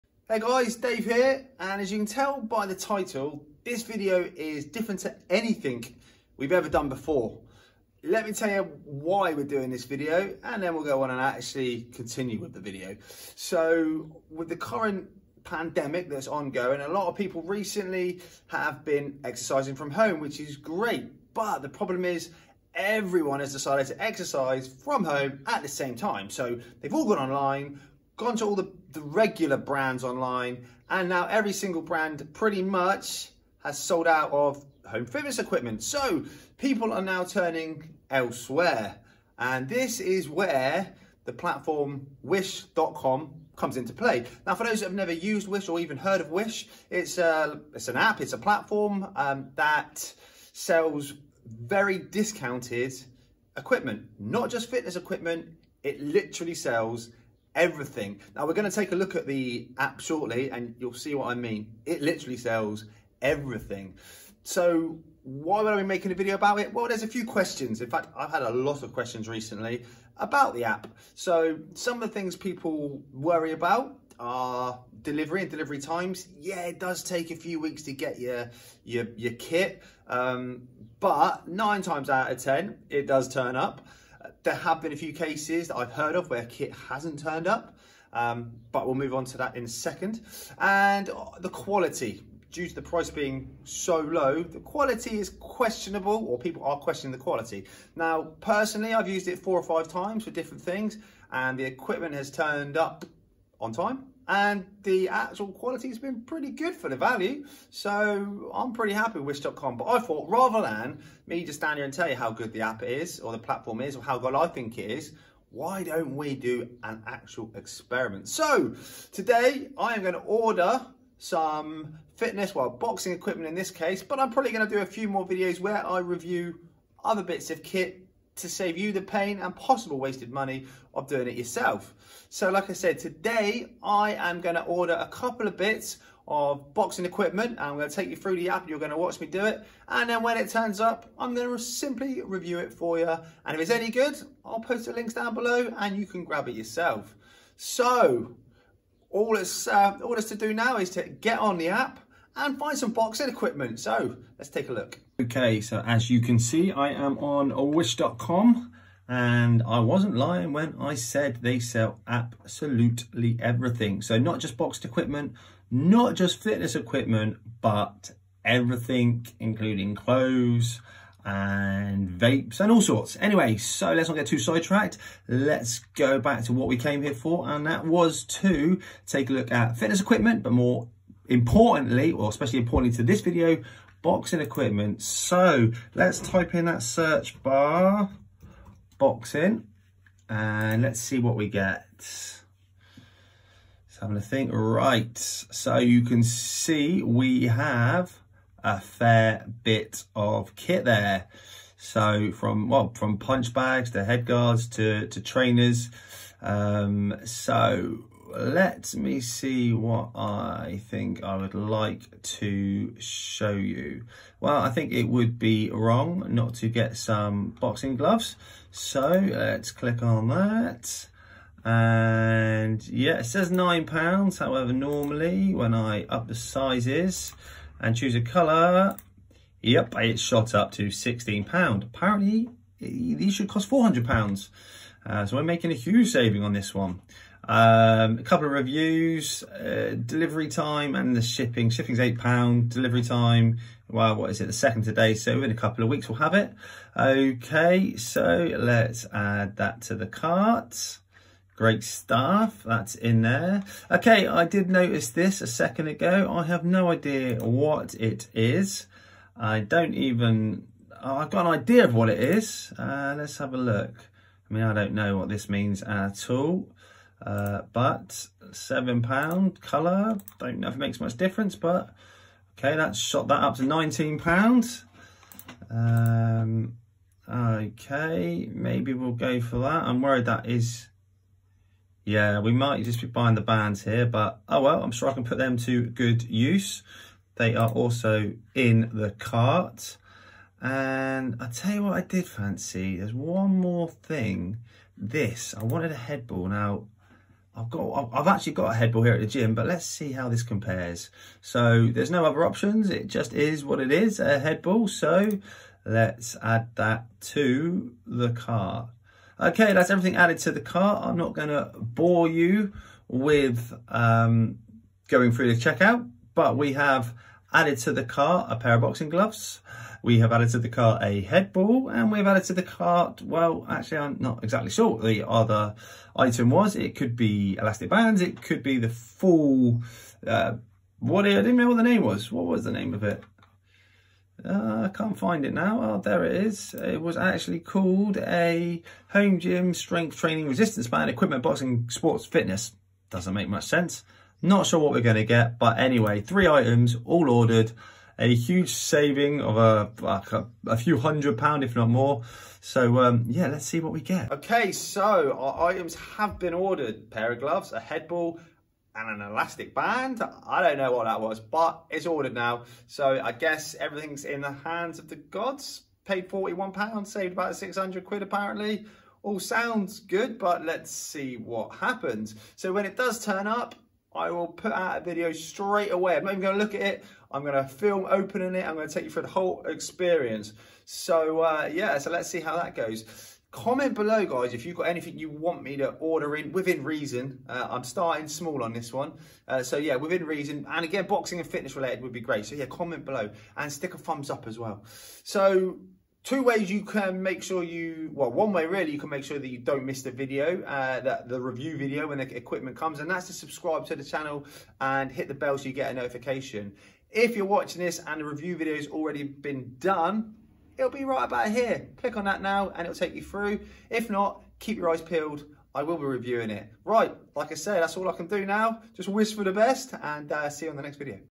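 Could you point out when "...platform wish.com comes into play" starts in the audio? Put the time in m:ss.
0:41.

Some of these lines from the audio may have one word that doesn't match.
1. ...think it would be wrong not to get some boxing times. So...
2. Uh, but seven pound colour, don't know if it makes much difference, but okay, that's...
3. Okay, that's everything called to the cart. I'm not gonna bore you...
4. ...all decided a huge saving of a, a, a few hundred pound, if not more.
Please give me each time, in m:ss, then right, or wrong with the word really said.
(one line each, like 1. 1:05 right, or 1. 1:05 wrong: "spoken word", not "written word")
1. 3:34 wrong: "gloves", not "times"
2. 4:27 right
3. 5:09 wrong: "added", not "called"
4. 5:47 wrong: "ordered", not "decided".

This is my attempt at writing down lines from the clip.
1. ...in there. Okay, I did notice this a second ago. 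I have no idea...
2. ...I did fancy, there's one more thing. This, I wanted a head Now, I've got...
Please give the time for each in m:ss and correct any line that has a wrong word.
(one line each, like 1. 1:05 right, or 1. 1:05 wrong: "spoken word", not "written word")
1. 4:12 right
2. 4:51 right.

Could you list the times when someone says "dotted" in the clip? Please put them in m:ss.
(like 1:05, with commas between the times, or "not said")
not said.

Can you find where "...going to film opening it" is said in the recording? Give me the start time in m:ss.
6:17.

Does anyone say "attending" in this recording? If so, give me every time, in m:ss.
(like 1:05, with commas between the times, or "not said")
not said.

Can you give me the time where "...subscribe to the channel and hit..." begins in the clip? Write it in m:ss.
6:43.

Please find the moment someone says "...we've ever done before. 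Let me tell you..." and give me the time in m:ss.
0:06.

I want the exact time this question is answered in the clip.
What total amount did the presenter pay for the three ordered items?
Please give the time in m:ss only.
6:06.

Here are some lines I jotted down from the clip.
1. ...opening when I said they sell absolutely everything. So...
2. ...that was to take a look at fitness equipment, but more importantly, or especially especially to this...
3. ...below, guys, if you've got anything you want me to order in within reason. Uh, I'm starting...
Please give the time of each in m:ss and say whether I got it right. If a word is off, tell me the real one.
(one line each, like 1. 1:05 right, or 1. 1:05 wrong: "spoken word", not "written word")
1. 2:40 wrong: "lying", not "opening"
2. 2:57 wrong: "importantly", not "especially"
3. 6:23 right.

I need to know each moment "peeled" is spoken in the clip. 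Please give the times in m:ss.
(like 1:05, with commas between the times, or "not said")
6:55.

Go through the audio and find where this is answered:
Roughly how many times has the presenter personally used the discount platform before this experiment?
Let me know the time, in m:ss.
1:39.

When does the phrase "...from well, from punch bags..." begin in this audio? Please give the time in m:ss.
3:22.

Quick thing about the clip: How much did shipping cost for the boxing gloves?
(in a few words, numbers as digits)
£8.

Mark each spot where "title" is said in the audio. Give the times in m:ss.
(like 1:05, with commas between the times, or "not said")
0:02.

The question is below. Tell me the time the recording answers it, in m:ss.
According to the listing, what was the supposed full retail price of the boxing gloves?
3:53.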